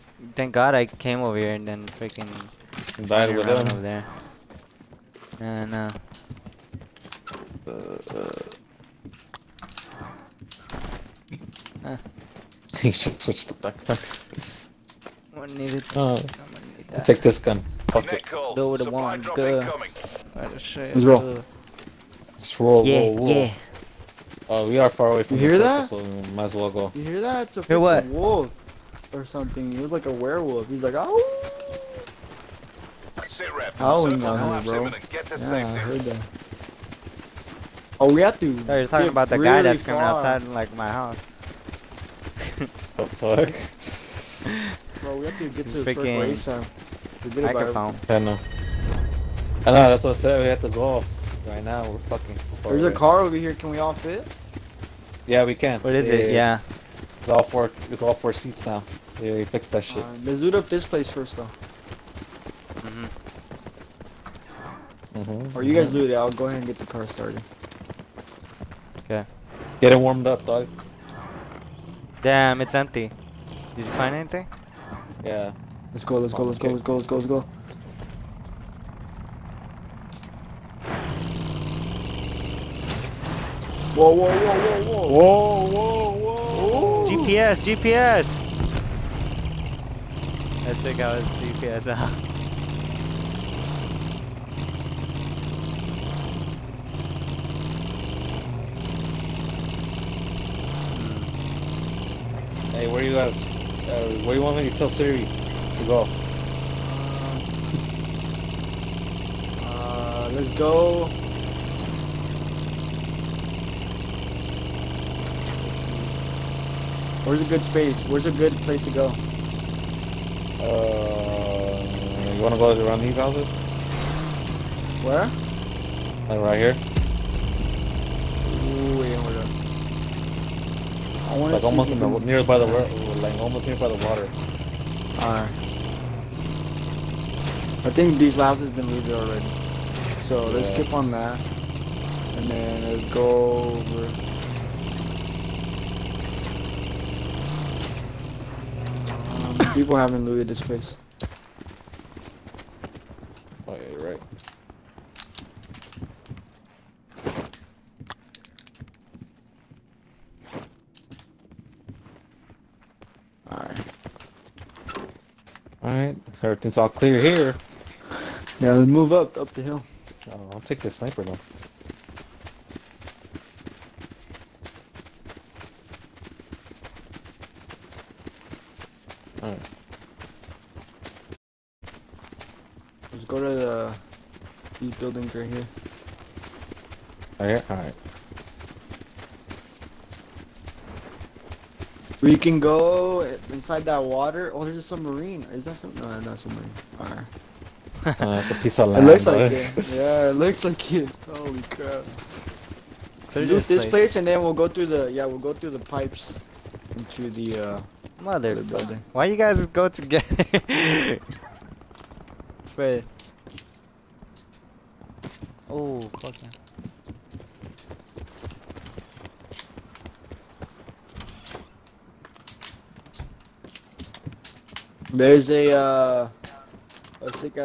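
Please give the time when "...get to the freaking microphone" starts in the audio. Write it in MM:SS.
00:45.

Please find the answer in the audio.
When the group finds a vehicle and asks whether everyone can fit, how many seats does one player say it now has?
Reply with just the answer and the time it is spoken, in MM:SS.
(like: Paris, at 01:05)
4, at 00:57.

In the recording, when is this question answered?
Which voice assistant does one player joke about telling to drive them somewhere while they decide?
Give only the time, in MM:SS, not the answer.
01:44.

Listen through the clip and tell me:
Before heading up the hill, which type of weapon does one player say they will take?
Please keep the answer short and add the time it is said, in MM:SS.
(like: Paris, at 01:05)
sniper, at 02:50.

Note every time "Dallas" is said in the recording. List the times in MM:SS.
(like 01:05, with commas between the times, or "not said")
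not said.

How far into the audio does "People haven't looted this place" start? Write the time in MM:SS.
02:29.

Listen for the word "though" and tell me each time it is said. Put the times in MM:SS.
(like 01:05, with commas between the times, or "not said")
01:01, 02:51.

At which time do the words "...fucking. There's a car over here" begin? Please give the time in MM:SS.
00:51.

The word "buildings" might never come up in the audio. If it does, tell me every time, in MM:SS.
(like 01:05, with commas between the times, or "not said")
03:04, 03:28.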